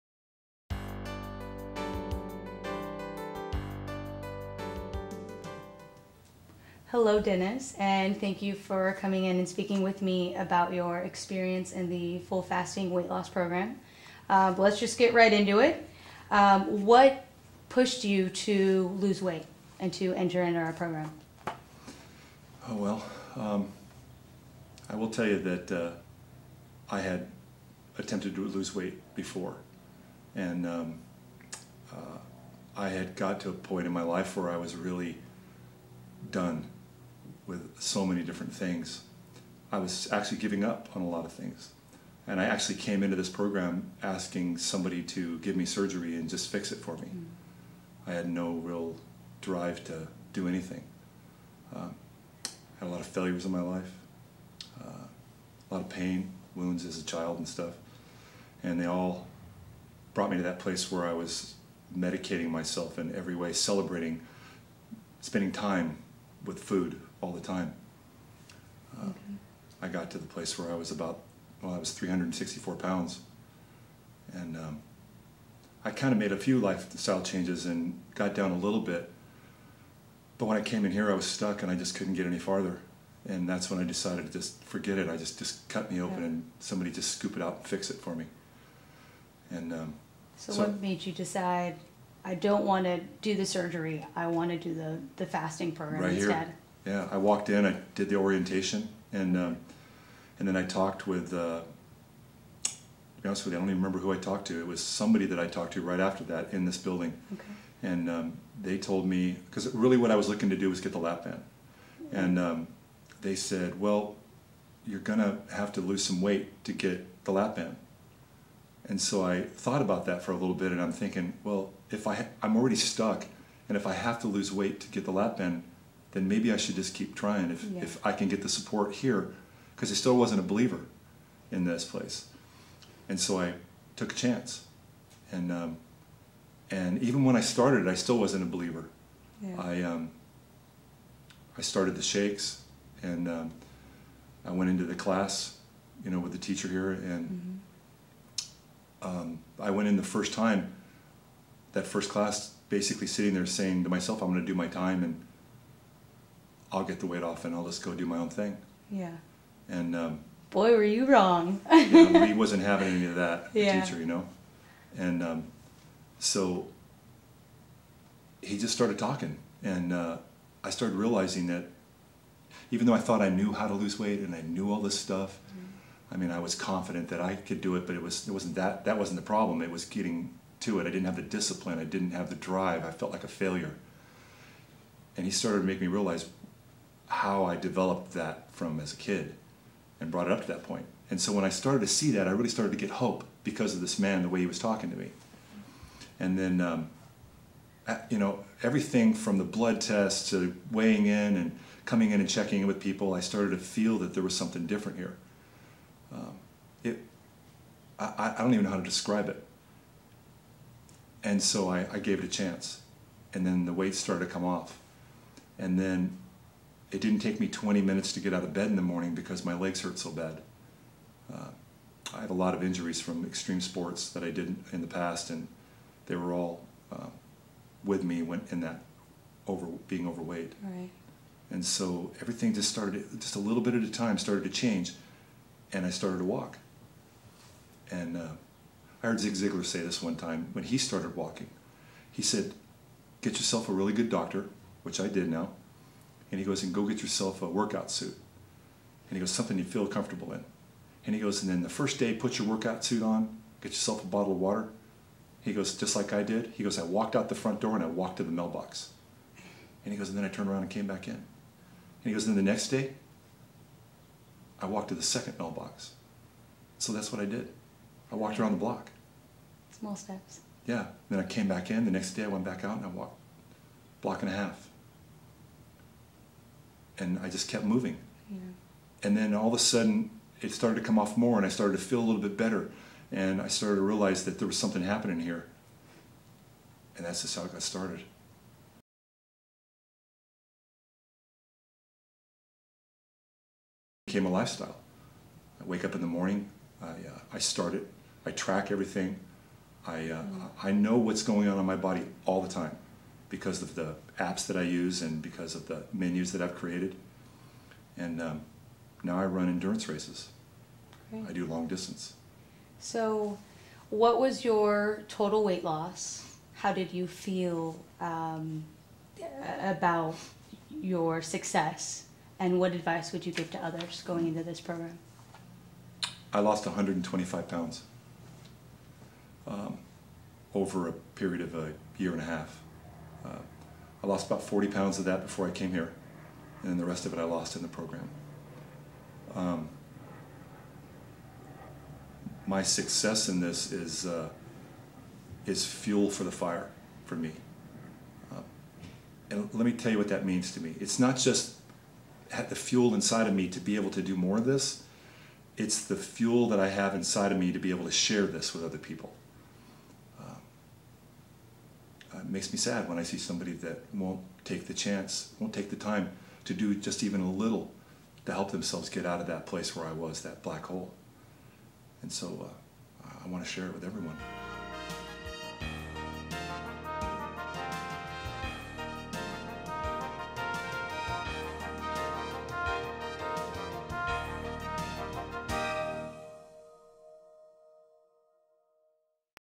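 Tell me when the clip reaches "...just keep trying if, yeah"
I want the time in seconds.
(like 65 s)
126 s.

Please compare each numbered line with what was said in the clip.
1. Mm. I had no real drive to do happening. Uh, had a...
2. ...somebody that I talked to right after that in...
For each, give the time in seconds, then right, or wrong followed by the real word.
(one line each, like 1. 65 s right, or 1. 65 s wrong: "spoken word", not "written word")
1. 47 s wrong: "anything", not "happening"
2. 104 s right.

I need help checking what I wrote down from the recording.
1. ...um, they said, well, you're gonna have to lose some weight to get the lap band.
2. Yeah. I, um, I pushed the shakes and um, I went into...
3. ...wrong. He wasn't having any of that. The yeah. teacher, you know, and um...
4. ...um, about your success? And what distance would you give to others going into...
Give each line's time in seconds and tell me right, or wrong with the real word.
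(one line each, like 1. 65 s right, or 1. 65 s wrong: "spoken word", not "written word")
1. 112 s right
2. 139 s wrong: "started", not "pushed"
3. 161 s right
4. 317 s wrong: "advice", not "distance".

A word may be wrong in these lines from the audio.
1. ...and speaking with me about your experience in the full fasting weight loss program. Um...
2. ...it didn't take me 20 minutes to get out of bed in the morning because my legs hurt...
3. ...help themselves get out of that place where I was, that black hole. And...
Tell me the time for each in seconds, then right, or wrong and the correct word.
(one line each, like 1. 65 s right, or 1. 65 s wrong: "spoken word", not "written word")
1. 9 s right
2. 216 s right
3. 368 s right.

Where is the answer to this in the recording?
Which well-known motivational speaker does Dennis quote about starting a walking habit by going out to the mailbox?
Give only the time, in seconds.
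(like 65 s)
239 s.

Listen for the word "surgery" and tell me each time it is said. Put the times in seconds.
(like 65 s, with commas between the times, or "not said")
45 s, 93 s.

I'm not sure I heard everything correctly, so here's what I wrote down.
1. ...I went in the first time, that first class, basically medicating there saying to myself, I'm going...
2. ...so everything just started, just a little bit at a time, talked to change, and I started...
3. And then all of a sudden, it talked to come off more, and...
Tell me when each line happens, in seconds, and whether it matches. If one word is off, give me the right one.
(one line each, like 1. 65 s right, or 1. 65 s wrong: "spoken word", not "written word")
1. 149 s wrong: "sitting", not "medicating"
2. 231 s wrong: "started", not "talked"
3. 279 s wrong: "started", not "talked".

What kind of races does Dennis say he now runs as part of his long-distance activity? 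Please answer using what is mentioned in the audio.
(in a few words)
endurance races.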